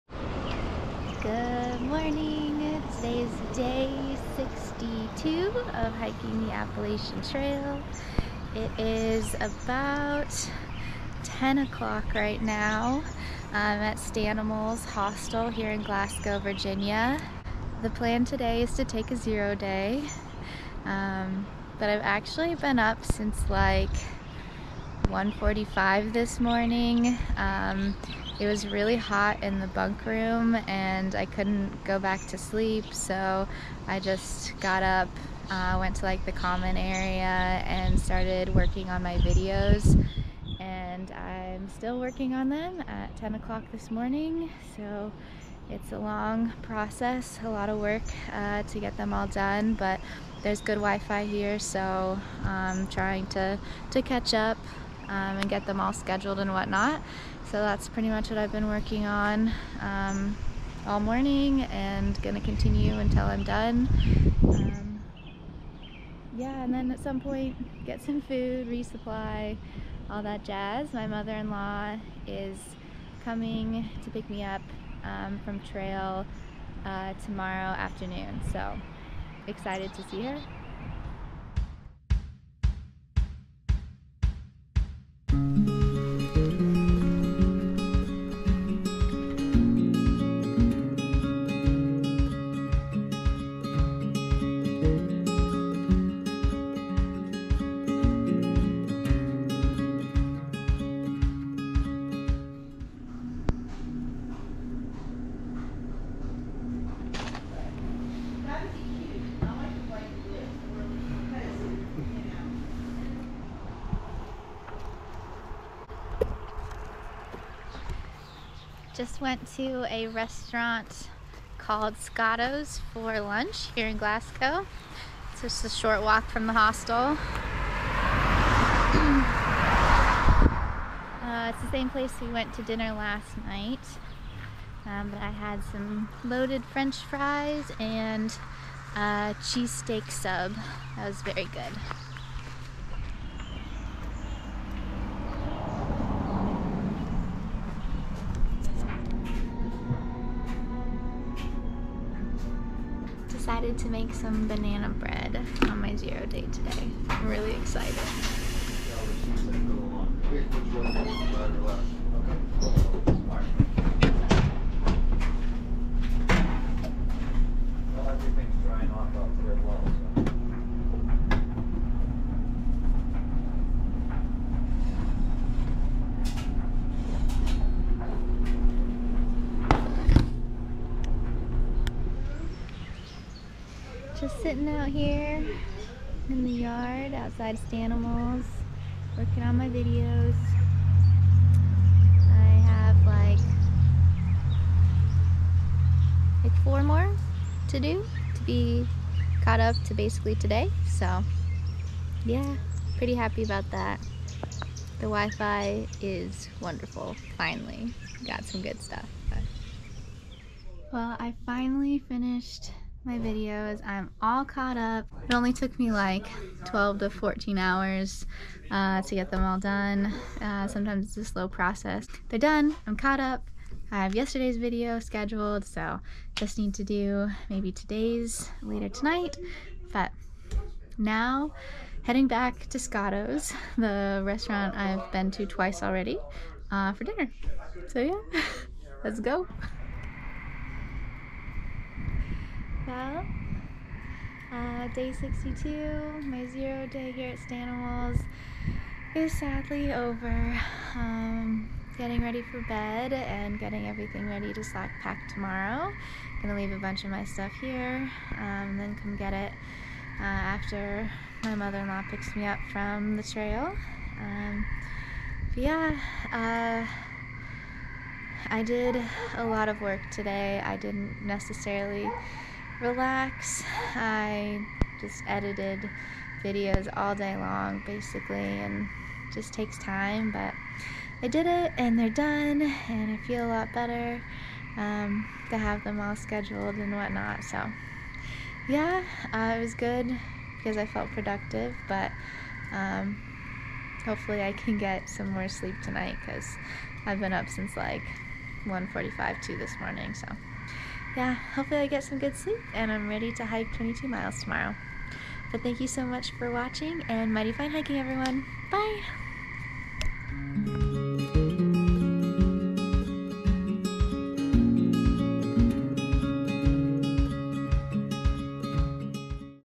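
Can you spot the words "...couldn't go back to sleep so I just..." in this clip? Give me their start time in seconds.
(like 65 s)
31 s.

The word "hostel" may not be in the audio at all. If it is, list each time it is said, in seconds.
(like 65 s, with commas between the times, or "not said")
14 s, 126 s.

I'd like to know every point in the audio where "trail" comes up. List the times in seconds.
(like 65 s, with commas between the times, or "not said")
7 s, 75 s, 263 s.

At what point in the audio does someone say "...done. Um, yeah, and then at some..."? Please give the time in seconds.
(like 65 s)
63 s.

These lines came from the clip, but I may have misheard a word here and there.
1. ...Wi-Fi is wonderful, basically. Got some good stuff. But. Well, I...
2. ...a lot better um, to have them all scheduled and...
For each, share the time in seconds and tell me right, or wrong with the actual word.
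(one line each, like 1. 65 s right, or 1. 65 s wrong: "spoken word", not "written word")
1. 205 s wrong: "finally", not "basically"
2. 283 s right.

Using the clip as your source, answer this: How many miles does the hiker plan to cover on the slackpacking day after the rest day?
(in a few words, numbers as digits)
22.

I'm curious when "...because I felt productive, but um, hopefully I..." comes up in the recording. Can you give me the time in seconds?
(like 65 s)
290 s.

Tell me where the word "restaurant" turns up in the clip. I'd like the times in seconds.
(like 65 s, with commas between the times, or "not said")
120 s, 234 s.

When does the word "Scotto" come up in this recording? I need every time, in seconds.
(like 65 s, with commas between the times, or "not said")
121 s, 232 s.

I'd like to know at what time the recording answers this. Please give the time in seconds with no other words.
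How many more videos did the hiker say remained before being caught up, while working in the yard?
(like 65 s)
196 s.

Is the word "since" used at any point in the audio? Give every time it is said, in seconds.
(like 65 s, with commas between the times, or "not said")
23 s, 297 s.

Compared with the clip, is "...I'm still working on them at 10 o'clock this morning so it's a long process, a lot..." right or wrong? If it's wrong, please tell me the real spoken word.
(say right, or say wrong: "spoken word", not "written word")
right.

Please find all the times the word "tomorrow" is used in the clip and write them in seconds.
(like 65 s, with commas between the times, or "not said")
77 s, 255 s, 304 s.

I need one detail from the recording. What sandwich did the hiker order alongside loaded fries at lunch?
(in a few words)
Cheesesteak sub.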